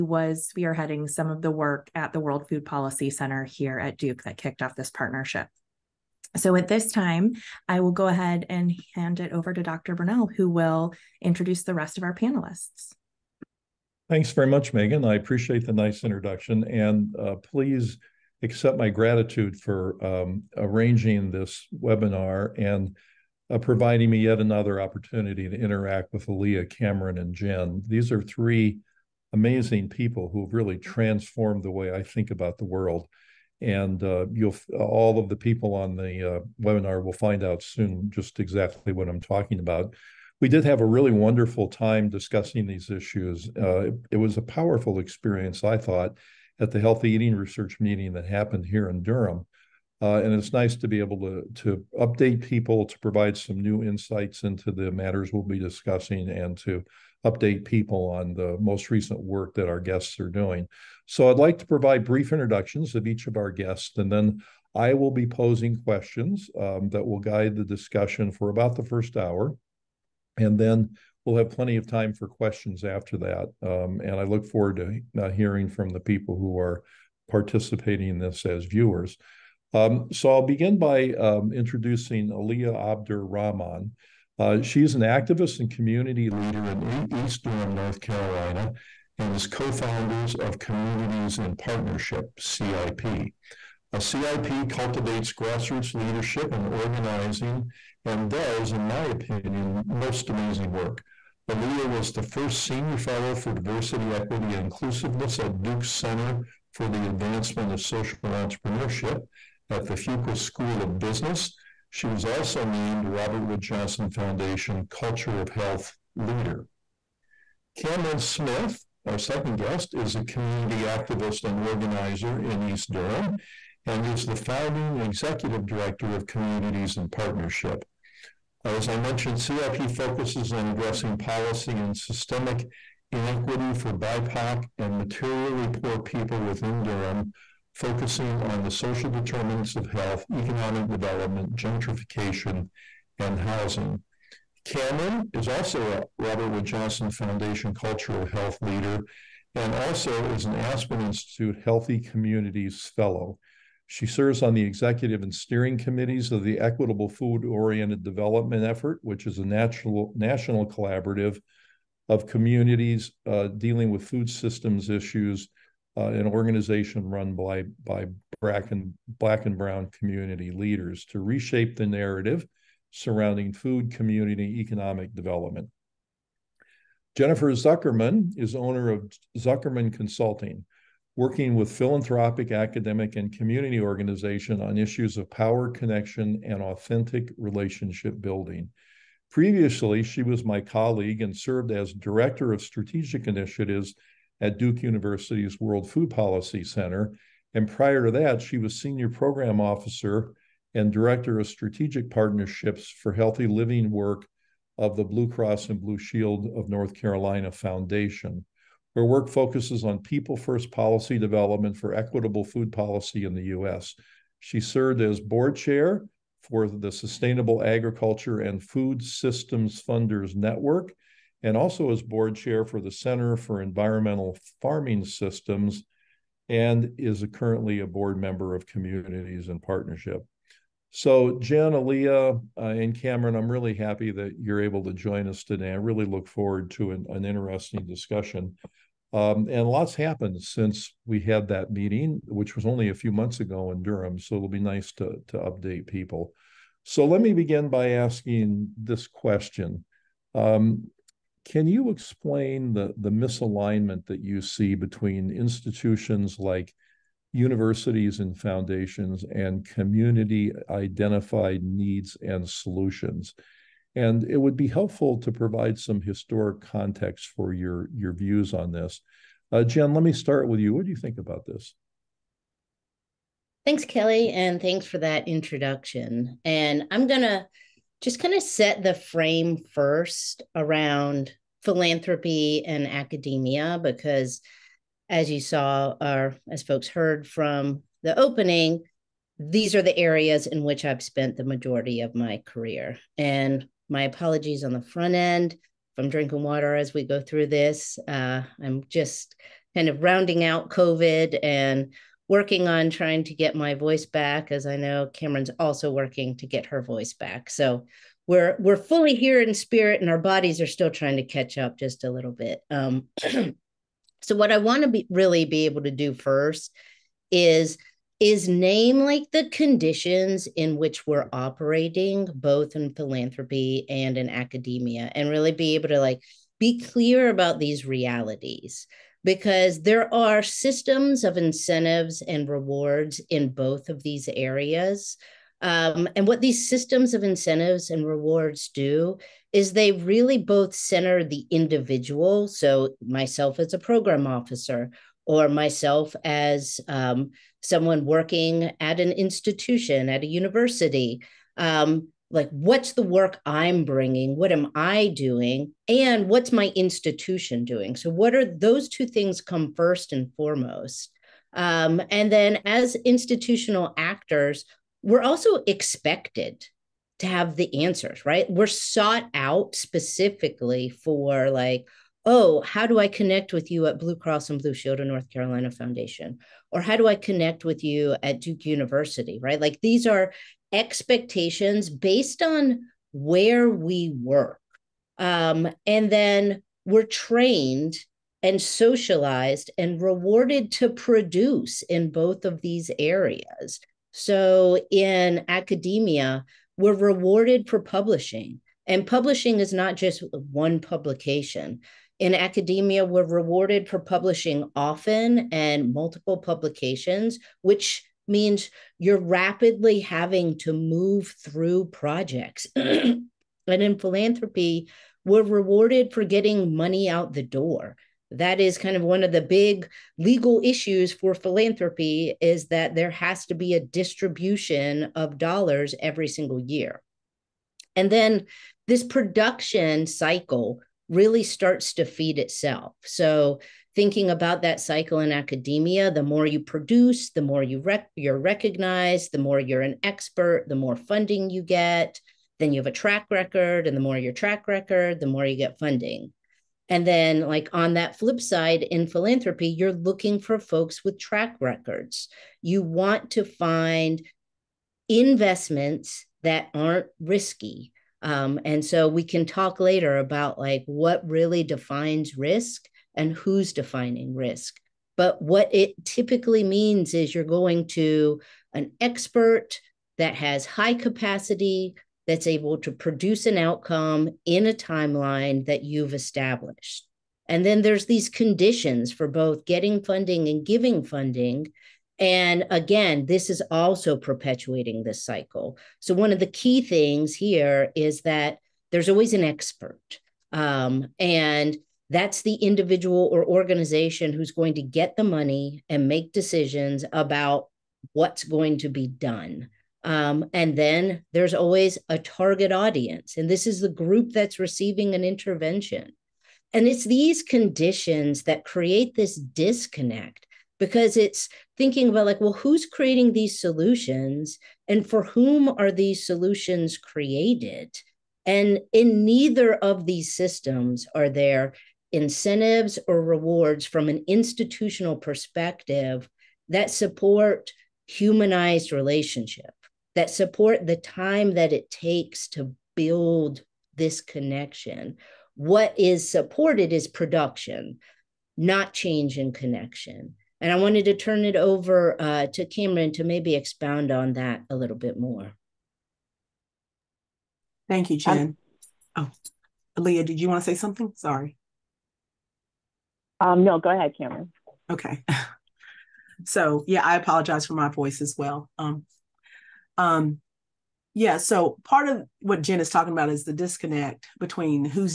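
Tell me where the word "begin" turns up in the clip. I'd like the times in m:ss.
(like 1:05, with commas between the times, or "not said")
1:20, 4:07.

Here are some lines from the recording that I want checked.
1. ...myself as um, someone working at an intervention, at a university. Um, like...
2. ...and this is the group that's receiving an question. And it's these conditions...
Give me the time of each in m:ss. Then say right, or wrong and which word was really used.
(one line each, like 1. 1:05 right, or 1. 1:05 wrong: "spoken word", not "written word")
1. 5:45 wrong: "institution", not "intervention"
2. 8:23 wrong: "intervention", not "question".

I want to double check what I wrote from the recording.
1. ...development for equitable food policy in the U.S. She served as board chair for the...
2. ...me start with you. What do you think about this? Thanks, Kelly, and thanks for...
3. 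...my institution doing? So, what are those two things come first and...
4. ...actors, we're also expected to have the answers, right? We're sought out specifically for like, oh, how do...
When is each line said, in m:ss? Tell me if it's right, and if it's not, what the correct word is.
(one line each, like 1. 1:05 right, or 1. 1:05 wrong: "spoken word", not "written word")
1. 3:31 right
2. 4:30 right
3. 5:56 right
4. 6:03 right.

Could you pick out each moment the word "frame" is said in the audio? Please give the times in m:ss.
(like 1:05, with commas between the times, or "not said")
4:38.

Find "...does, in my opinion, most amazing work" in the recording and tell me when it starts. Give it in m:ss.
1:38.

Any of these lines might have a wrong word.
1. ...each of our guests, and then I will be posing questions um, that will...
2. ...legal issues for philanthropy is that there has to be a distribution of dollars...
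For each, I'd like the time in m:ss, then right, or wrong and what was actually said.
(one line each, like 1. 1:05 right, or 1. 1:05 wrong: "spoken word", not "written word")
1. 1:03 right
2. 7:00 right.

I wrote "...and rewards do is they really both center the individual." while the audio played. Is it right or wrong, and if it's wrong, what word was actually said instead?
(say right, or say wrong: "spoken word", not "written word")
right.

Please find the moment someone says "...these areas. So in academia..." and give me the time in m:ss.
6:32.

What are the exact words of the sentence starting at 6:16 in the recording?
Or how do I connect with you at Duke University, right?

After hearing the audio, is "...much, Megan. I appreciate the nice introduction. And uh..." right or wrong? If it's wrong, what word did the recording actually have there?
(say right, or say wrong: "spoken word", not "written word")
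right.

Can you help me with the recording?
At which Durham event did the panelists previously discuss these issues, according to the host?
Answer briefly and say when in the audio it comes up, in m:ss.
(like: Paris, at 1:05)
Healthy Eating Research meeting, at 0:46.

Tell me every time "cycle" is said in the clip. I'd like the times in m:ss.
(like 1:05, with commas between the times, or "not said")
7:10, 7:14, 8:05.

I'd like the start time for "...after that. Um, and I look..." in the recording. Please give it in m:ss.
1:12.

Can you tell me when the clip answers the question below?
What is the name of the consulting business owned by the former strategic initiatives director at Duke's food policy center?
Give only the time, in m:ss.
2:59.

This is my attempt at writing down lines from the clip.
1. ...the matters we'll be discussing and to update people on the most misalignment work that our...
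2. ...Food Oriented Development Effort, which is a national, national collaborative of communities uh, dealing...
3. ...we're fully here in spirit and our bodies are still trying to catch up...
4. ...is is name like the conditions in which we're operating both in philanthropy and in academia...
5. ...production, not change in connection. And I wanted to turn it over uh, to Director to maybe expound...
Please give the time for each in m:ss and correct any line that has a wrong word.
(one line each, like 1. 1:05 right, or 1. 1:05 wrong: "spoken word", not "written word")
1. 0:54 wrong: "recent", not "misalignment"
2. 2:37 right
3. 5:08 right
4. 5:17 right
5. 8:57 wrong: "Camryn", not "Director".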